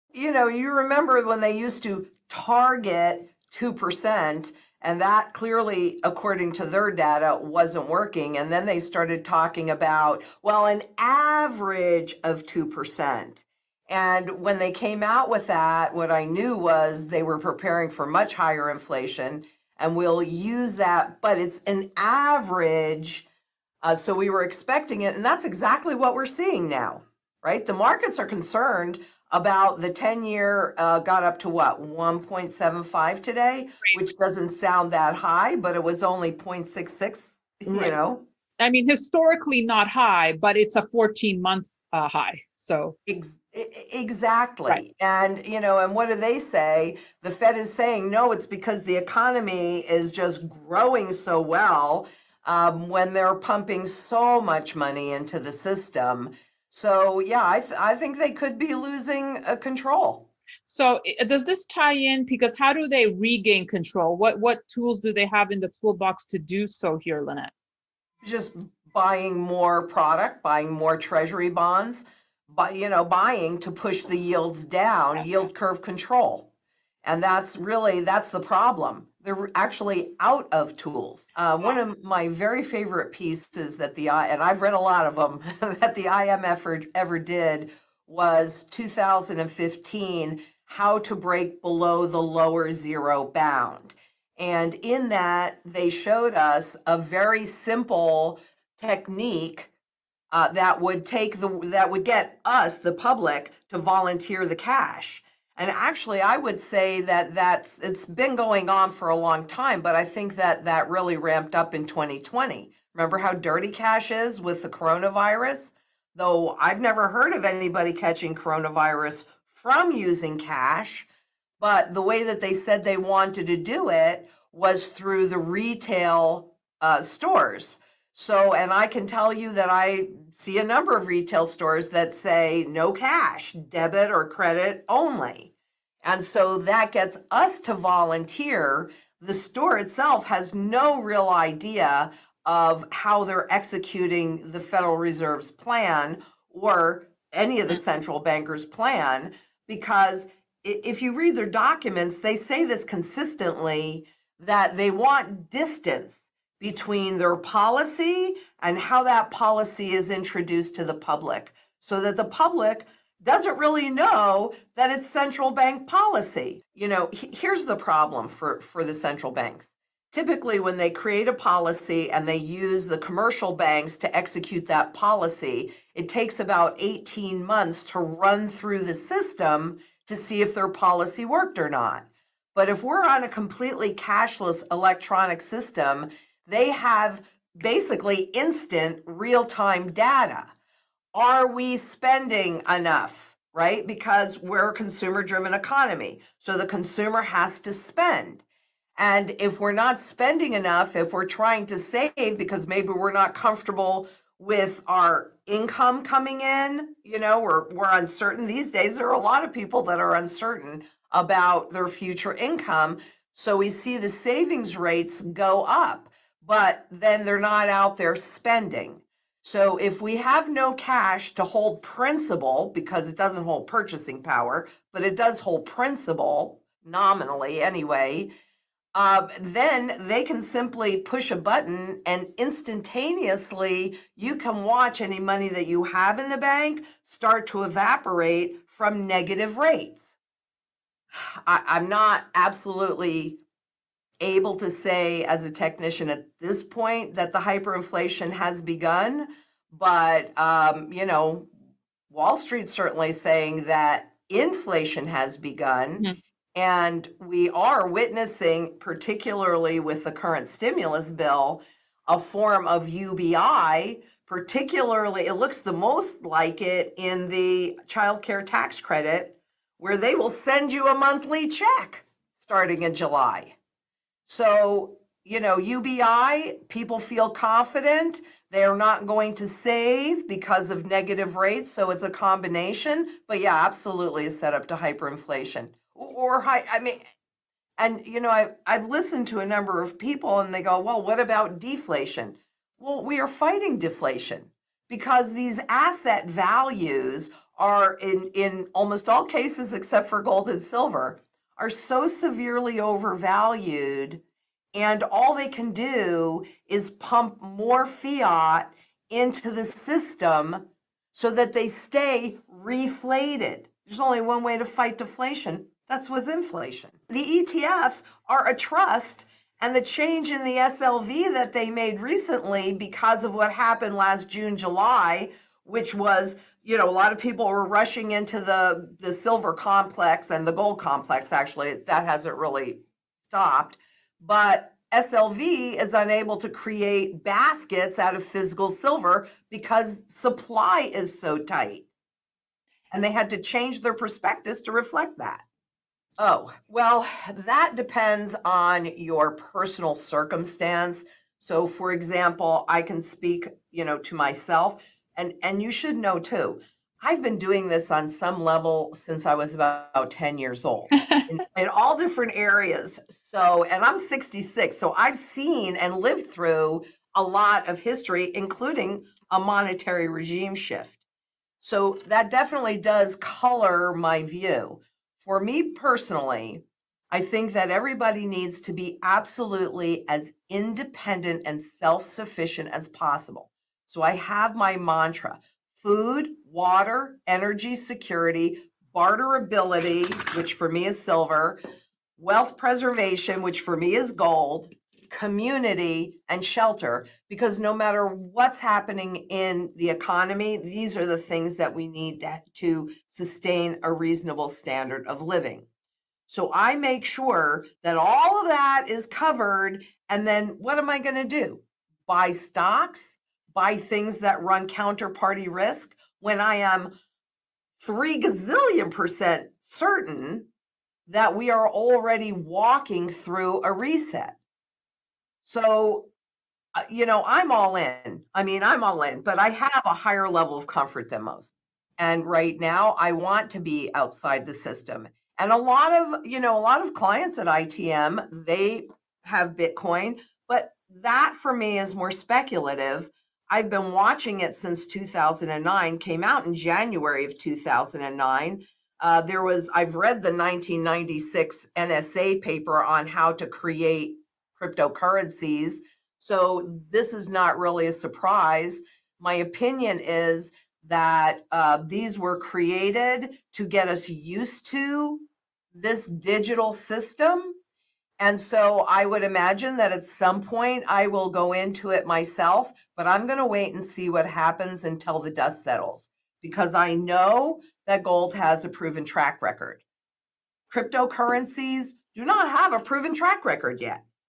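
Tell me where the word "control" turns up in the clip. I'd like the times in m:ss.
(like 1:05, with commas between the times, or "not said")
0:59, 1:03, 1:15.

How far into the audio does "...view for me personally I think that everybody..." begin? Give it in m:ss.
6:14.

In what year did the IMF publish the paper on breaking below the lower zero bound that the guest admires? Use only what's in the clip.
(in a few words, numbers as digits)
2015.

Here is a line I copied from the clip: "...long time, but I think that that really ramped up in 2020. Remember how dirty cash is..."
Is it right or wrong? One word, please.
right.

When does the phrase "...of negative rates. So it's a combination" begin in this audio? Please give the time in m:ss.
4:40.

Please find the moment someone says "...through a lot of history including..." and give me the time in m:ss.
6:06.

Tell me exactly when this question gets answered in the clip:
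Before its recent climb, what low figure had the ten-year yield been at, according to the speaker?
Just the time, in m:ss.
0:36.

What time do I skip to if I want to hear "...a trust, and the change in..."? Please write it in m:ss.
5:18.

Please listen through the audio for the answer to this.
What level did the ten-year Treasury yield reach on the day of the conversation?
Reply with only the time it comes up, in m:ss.
0:31.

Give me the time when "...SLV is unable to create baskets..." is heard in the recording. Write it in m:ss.
5:34.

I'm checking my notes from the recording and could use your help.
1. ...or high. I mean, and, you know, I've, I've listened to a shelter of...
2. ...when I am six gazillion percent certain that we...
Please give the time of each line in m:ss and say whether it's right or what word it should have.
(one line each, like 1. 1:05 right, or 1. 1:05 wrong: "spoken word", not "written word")
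1. 4:46 wrong: "number", not "shelter"
2. 6:56 wrong: "three", not "six".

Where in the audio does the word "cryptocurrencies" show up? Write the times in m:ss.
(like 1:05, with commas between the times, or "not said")
7:34, 8:00.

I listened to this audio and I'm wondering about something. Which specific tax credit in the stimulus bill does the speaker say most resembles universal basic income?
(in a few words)
child care tax credit.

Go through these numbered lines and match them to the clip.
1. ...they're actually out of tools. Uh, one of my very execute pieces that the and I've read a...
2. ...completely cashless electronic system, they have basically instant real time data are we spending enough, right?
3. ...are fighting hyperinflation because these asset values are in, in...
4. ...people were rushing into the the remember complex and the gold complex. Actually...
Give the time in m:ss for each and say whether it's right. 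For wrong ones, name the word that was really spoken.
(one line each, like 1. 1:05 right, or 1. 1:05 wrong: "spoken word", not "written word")
1. 1:19 wrong: "favorite", not "execute"
2. 3:03 right
3. 4:53 wrong: "deflation", not "hyperinflation"
4. 5:27 wrong: "silver", not "remember".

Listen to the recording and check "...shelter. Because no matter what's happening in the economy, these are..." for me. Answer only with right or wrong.
right.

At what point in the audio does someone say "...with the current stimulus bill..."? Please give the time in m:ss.
4:19.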